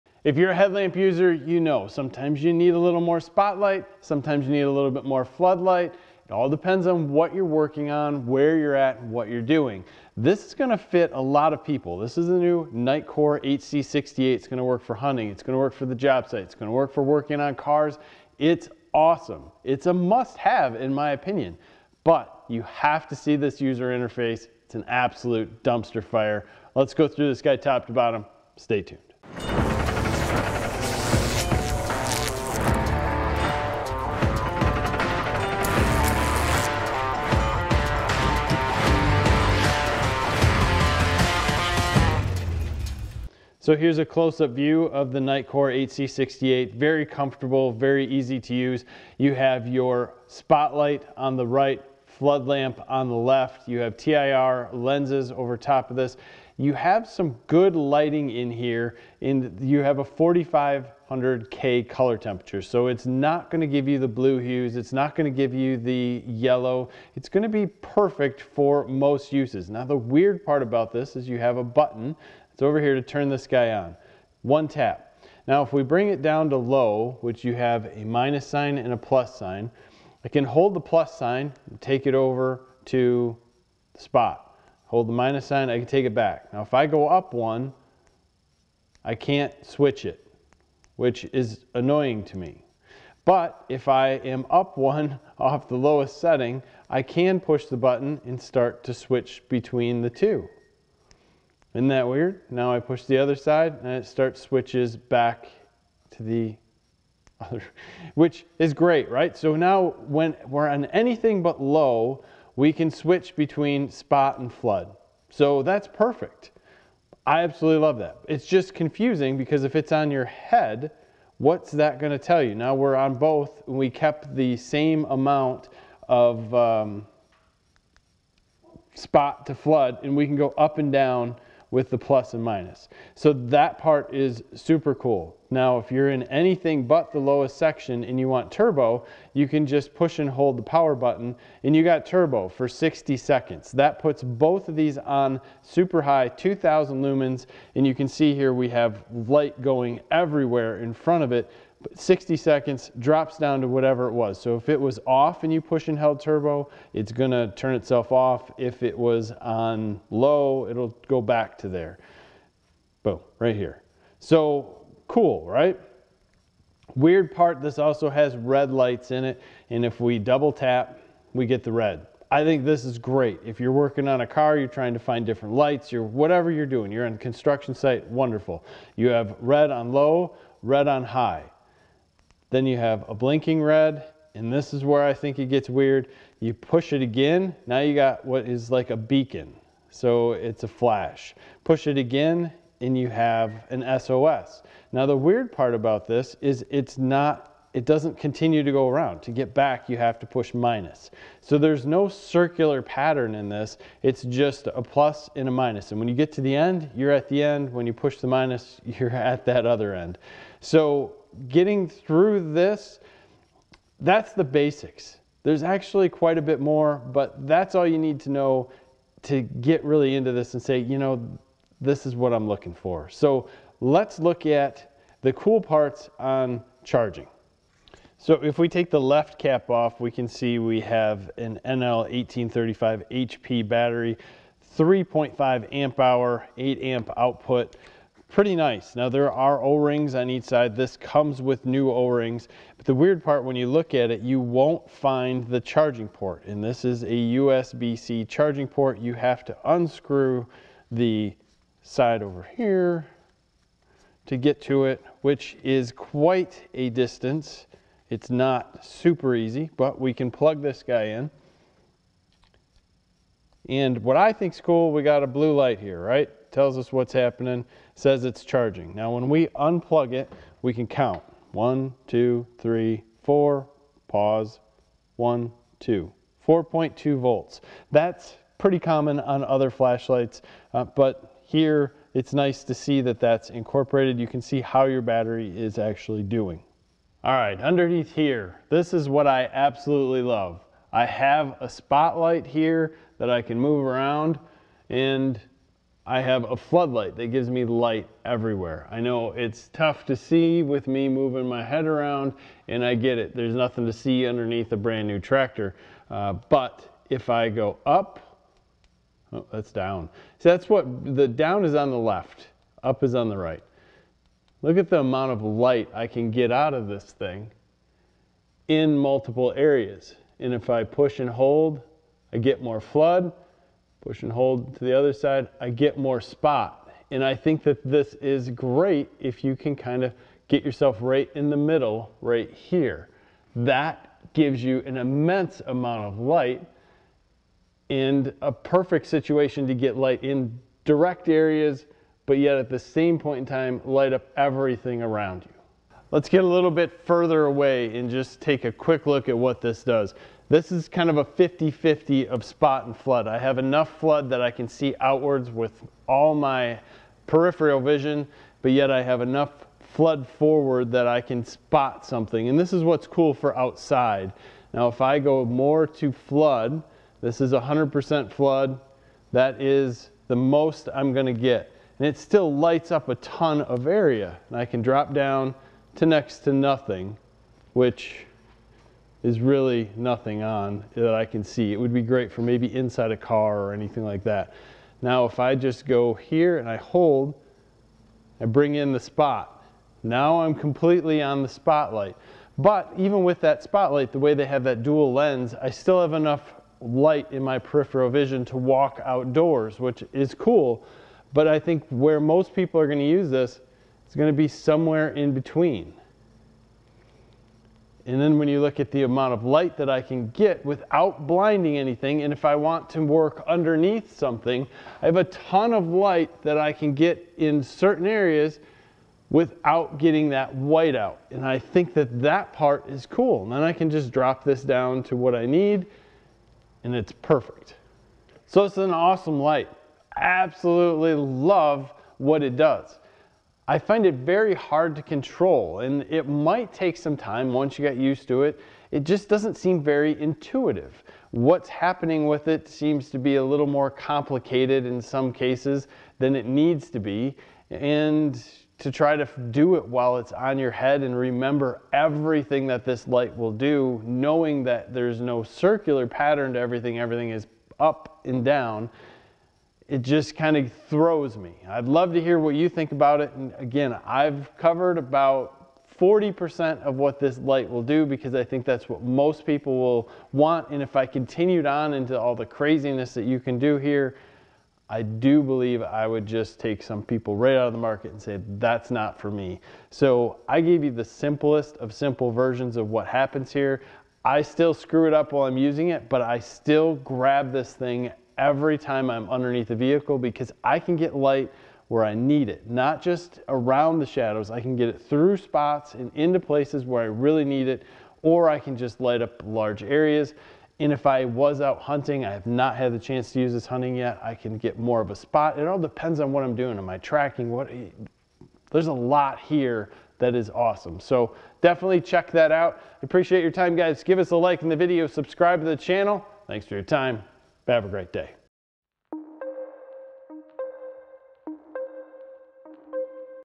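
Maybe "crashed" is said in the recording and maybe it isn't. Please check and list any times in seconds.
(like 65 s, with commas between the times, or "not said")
not said.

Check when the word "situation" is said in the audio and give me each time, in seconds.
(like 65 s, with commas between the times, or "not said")
339 s.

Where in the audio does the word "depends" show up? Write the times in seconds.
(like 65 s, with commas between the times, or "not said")
6 s, 505 s.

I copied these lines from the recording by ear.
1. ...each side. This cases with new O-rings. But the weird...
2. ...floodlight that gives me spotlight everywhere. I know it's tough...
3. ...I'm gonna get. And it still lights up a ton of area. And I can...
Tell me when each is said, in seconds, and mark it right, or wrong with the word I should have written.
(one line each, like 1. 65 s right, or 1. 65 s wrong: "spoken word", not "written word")
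1. 240 s wrong: "comes", not "cases"
2. 296 s wrong: "light", not "spotlight"
3. 370 s right.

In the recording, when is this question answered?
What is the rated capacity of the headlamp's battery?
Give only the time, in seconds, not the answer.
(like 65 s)
234 s.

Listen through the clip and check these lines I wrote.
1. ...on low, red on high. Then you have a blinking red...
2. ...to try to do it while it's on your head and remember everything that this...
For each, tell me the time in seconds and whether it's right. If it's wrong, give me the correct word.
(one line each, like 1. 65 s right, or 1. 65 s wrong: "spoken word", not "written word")
1. 179 s right
2. 448 s right.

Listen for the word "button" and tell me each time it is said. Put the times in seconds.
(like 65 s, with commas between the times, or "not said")
71 s, 97 s, 140 s.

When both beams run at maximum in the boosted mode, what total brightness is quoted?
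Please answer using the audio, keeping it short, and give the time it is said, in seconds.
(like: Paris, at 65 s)
2000 lumens, at 146 s.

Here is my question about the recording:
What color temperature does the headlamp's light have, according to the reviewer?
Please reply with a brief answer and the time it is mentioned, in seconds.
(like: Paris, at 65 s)
4500K, at 60 s.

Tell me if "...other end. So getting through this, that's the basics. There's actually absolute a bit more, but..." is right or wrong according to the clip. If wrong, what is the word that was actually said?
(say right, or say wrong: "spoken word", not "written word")
wrong: "quite", not "absolute".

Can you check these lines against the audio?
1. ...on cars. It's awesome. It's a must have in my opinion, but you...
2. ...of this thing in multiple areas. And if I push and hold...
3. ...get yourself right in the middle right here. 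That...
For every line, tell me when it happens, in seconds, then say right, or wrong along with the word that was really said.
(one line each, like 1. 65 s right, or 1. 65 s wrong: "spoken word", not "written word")
1. 17 s right
2. 316 s right
3. 330 s right.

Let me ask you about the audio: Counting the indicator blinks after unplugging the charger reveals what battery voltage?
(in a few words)
4.2 volts.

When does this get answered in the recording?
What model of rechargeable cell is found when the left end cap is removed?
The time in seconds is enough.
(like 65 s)
231 s.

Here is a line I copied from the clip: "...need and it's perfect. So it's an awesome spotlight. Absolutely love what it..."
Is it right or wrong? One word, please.
wrong.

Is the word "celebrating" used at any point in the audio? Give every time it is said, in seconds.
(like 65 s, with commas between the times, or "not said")
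not said.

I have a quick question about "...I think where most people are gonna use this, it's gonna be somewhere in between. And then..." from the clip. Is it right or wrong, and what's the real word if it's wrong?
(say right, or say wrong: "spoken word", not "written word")
right.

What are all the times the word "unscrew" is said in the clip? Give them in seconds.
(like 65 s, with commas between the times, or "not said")
249 s.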